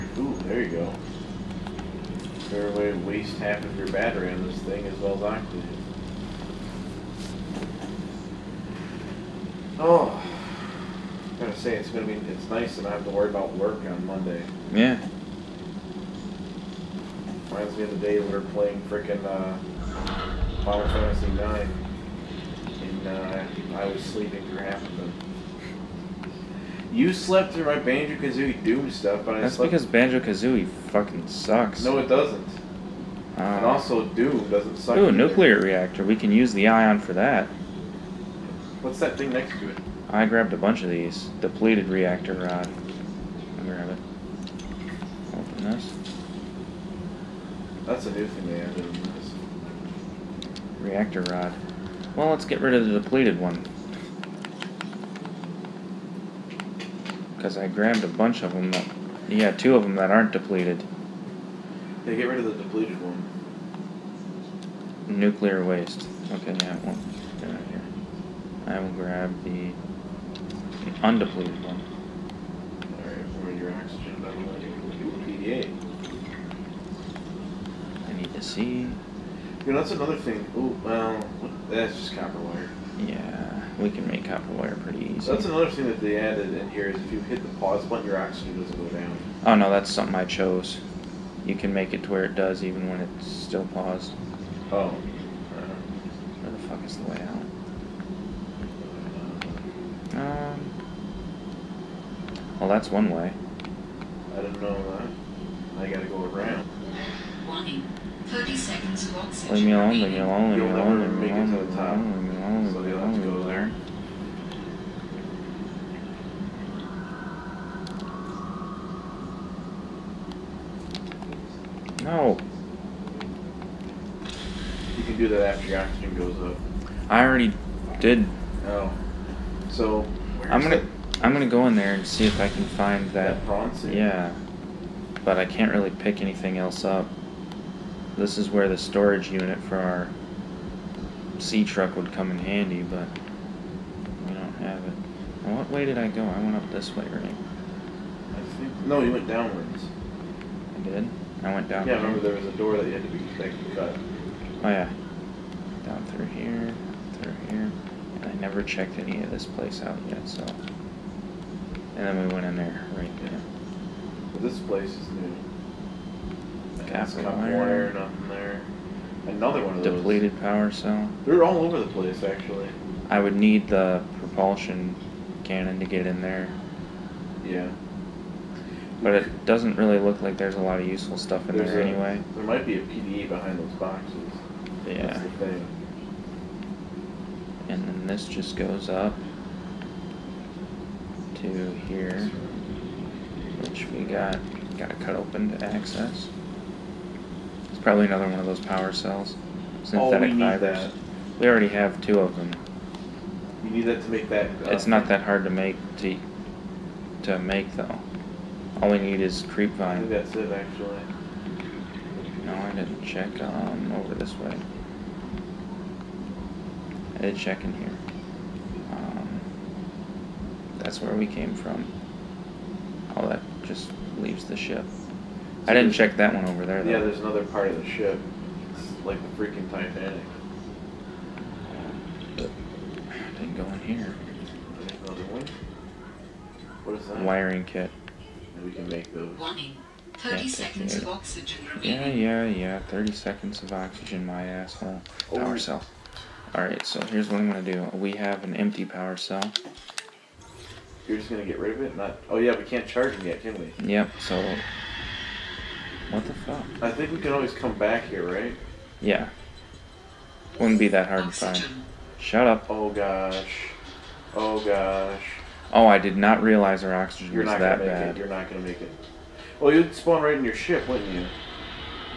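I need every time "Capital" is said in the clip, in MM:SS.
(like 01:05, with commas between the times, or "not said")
02:46.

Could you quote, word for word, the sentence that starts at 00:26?
You slept through my Banjo Kazooie Doom stuff, but I That's slept...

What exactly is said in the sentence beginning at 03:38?
Um, that's where we came from.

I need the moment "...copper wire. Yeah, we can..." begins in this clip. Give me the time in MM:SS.
01:22.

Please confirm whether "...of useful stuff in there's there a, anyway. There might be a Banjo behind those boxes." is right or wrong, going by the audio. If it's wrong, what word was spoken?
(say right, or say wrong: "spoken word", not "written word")
wrong: "PDA", not "Banjo".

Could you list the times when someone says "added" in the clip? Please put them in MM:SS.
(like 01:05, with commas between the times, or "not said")
00:48, 01:26.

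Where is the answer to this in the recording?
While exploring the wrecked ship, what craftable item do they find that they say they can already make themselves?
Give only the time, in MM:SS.
03:57.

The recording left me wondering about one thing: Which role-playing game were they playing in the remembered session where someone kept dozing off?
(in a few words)
Final Fantasy IX.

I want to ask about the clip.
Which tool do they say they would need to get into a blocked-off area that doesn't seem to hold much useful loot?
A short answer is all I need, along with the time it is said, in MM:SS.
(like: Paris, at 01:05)
propulsion cannon, at 02:54.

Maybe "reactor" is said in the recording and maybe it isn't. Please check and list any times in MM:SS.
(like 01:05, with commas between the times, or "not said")
00:35, 00:41, 00:50.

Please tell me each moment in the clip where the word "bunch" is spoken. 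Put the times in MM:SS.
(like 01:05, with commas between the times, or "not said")
00:40, 00:58.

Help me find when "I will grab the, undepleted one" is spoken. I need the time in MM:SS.
01:08.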